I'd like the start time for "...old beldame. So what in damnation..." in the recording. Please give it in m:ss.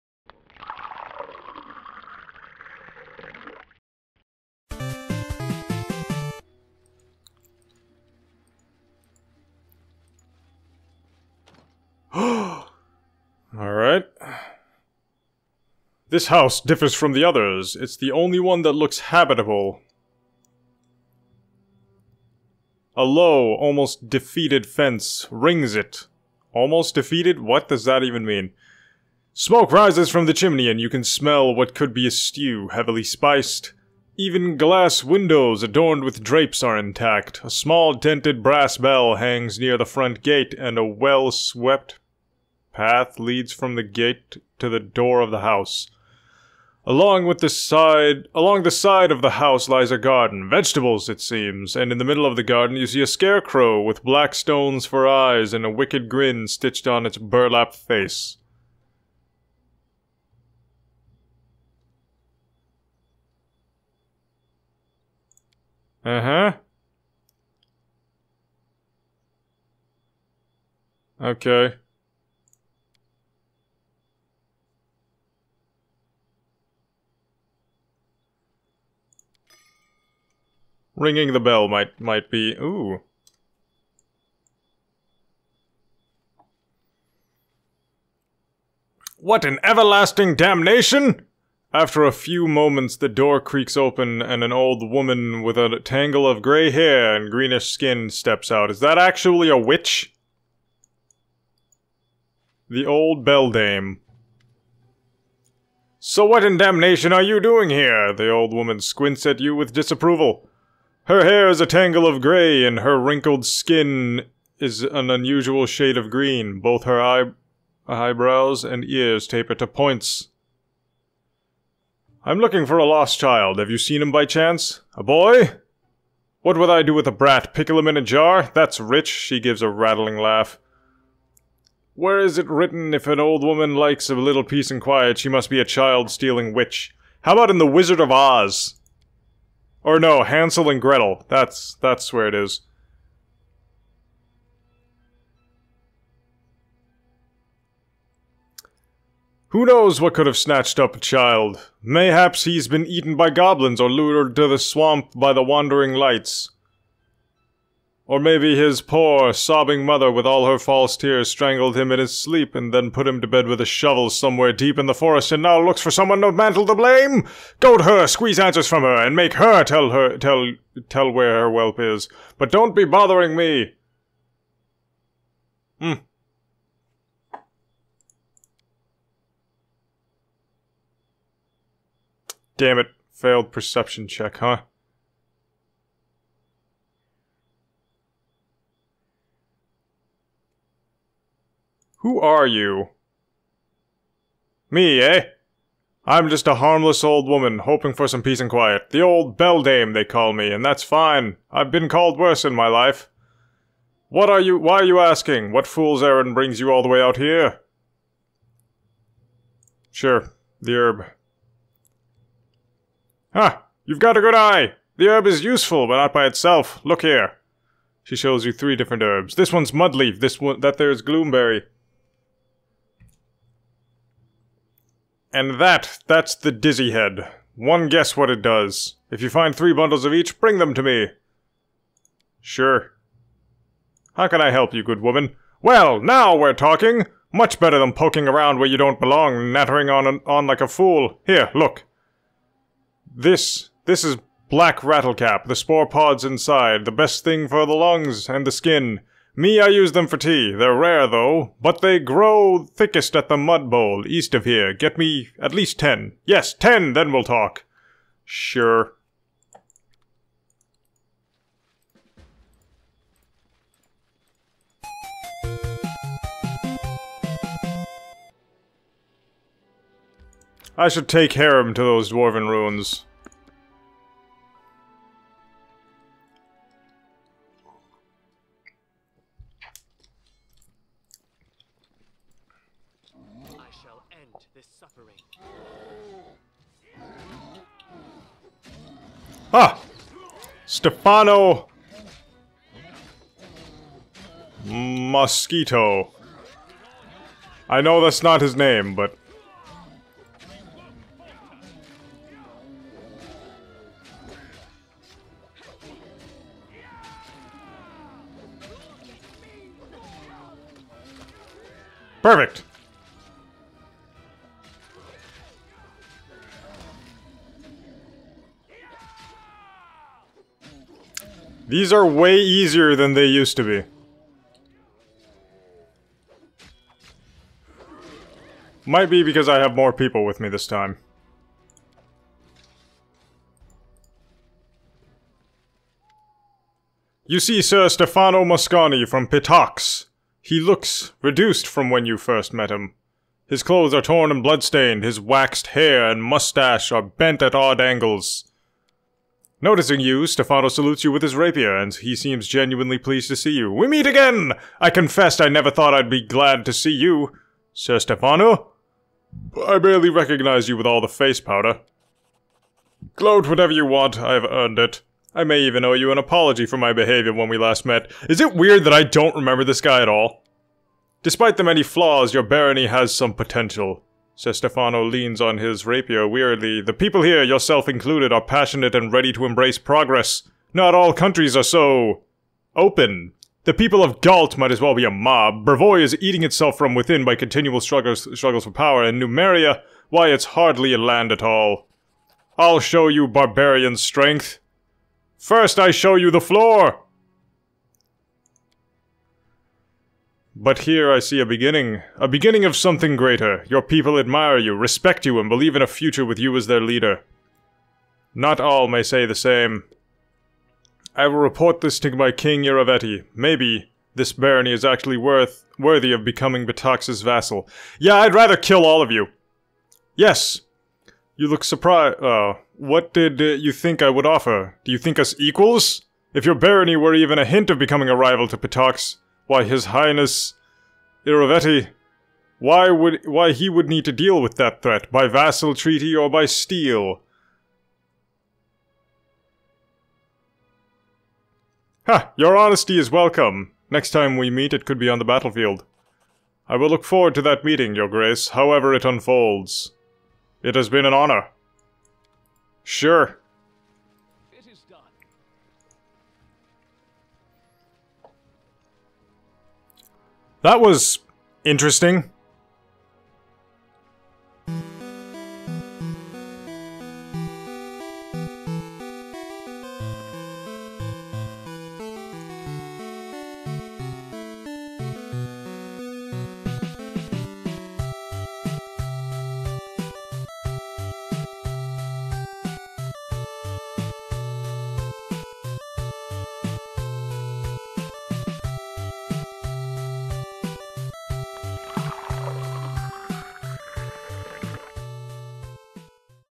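1:42.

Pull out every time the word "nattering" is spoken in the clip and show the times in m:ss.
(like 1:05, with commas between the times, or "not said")
3:59.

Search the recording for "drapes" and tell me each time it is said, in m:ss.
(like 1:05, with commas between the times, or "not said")
0:36.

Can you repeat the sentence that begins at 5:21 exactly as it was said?
These are way easier than they used to be.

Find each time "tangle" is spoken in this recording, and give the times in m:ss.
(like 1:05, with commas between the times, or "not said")
1:35, 1:51.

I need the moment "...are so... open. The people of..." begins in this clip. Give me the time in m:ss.
6:21.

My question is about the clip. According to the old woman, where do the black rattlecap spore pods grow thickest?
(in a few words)
The mud bowl.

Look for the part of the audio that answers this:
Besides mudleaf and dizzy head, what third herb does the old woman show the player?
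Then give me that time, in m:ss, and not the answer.
3:41.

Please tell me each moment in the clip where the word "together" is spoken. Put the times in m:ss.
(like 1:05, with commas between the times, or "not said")
not said.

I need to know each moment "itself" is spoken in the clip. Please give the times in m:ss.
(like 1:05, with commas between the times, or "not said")
3:36, 6:26.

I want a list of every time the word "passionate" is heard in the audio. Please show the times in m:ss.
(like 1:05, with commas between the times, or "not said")
6:18.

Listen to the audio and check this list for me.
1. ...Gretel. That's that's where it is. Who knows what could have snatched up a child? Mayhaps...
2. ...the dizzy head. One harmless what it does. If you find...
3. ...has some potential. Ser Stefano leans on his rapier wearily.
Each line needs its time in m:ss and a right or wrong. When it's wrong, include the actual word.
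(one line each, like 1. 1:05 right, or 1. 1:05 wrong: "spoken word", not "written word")
1. 2:20 right
2. 3:46 wrong: "guess", not "harmless"
3. 6:12 right.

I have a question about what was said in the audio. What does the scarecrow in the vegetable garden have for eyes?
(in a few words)
Black stones.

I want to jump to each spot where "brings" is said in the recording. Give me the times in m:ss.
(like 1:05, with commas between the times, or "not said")
3:26, 3:50.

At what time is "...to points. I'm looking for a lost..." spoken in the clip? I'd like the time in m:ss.
1:59.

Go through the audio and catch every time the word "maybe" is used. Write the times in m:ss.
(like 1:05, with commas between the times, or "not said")
2:38, 6:53.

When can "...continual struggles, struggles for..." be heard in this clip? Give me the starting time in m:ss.
6:27.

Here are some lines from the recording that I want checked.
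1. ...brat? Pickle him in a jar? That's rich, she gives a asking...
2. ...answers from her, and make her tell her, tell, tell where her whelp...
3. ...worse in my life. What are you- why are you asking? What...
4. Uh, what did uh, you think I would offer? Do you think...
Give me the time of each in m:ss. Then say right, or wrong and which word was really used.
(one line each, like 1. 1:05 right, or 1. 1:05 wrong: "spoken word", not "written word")
1. 2:07 wrong: "rattling", not "asking"
2. 2:48 right
3. 3:22 right
4. 7:02 right.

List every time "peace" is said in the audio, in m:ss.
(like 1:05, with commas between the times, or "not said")
2:14, 3:18.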